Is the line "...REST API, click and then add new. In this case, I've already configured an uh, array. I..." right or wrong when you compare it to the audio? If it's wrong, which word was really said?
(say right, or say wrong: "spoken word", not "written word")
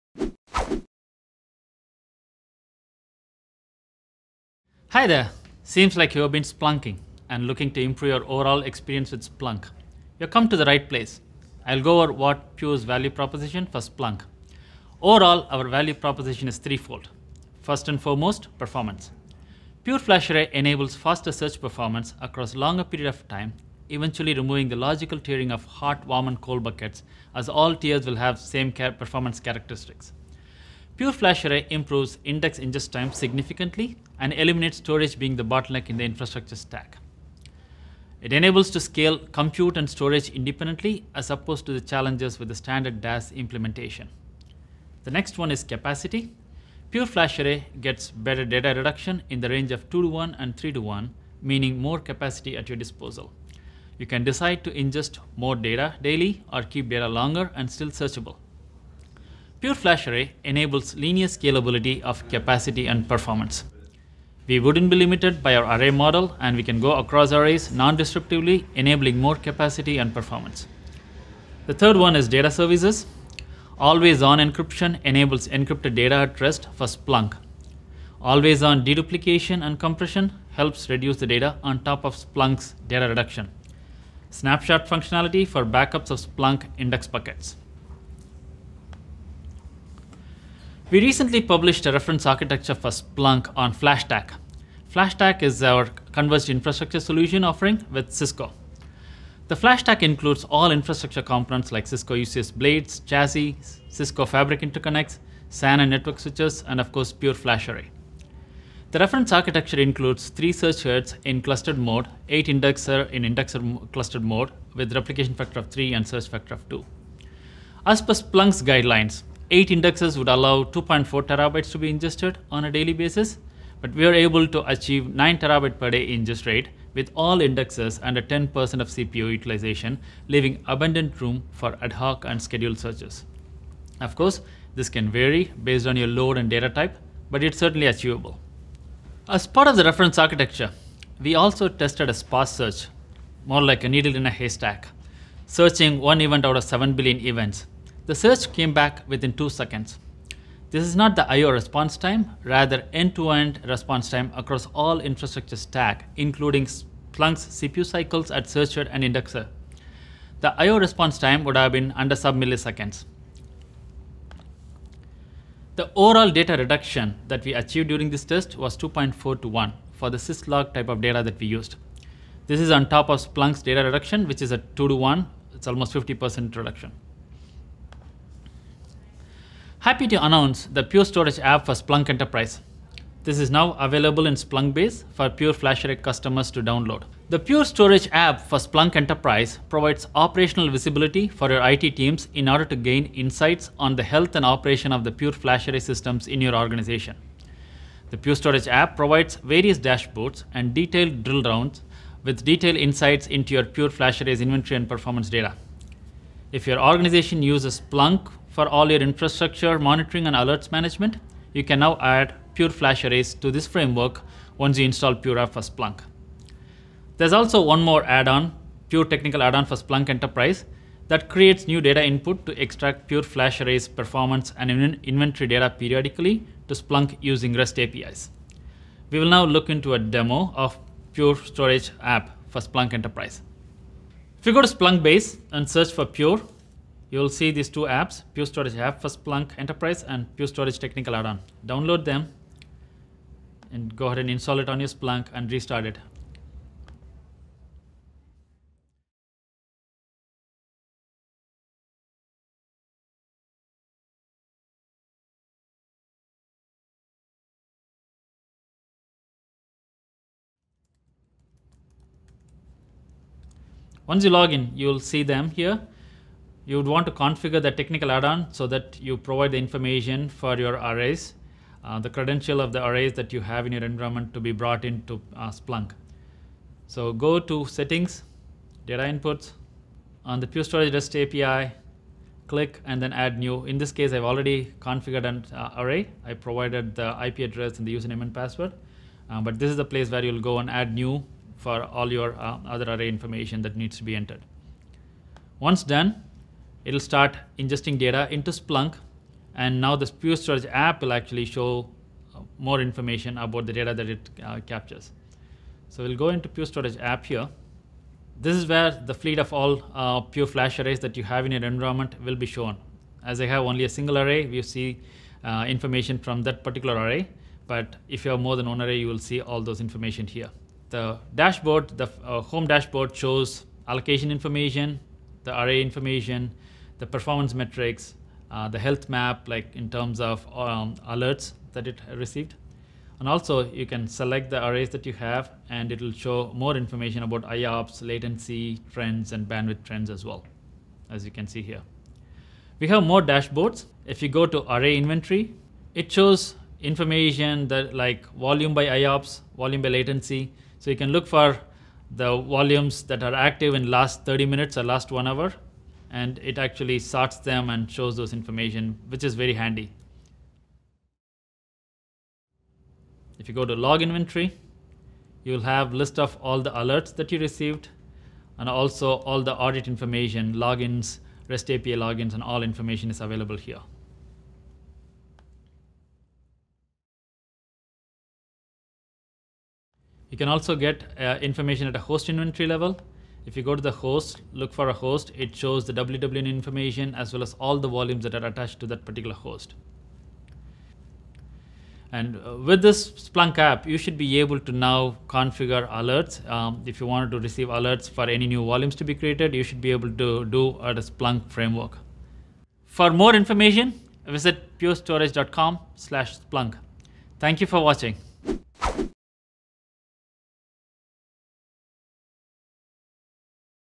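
right.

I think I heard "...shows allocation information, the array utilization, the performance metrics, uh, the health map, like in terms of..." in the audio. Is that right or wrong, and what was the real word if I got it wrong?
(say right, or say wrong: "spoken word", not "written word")
wrong: "information", not "utilization".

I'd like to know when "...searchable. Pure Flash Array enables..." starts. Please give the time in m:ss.
0:57.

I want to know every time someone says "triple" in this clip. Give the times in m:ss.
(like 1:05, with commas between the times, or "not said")
not said.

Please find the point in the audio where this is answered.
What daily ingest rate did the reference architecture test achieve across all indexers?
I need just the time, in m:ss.
2:05.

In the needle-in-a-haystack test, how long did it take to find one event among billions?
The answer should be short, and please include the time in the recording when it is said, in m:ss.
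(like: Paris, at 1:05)
two seconds, at 2:29.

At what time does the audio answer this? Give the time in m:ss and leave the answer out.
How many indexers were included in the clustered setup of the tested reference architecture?
1:52.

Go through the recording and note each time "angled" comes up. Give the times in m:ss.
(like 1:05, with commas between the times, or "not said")
not said.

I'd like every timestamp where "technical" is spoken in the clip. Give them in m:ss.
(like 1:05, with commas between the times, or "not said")
3:39, 4:00, 4:27.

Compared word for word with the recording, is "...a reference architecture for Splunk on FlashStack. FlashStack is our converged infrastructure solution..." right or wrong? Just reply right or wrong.
right.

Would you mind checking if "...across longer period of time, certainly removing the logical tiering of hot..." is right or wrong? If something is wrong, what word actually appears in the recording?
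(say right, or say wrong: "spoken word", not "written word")
wrong: "eventually", not "certainly".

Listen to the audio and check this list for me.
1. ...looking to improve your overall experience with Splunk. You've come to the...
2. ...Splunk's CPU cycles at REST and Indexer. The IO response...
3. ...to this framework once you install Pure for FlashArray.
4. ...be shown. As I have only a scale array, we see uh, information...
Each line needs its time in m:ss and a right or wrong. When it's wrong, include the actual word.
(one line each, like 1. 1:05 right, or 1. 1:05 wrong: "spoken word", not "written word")
1. 0:07 right
2. 2:36 wrong: "Searcher", not "REST"
3. 3:33 wrong: "Splunk", not "FlashArray"
4. 5:12 wrong: "single", not "scale".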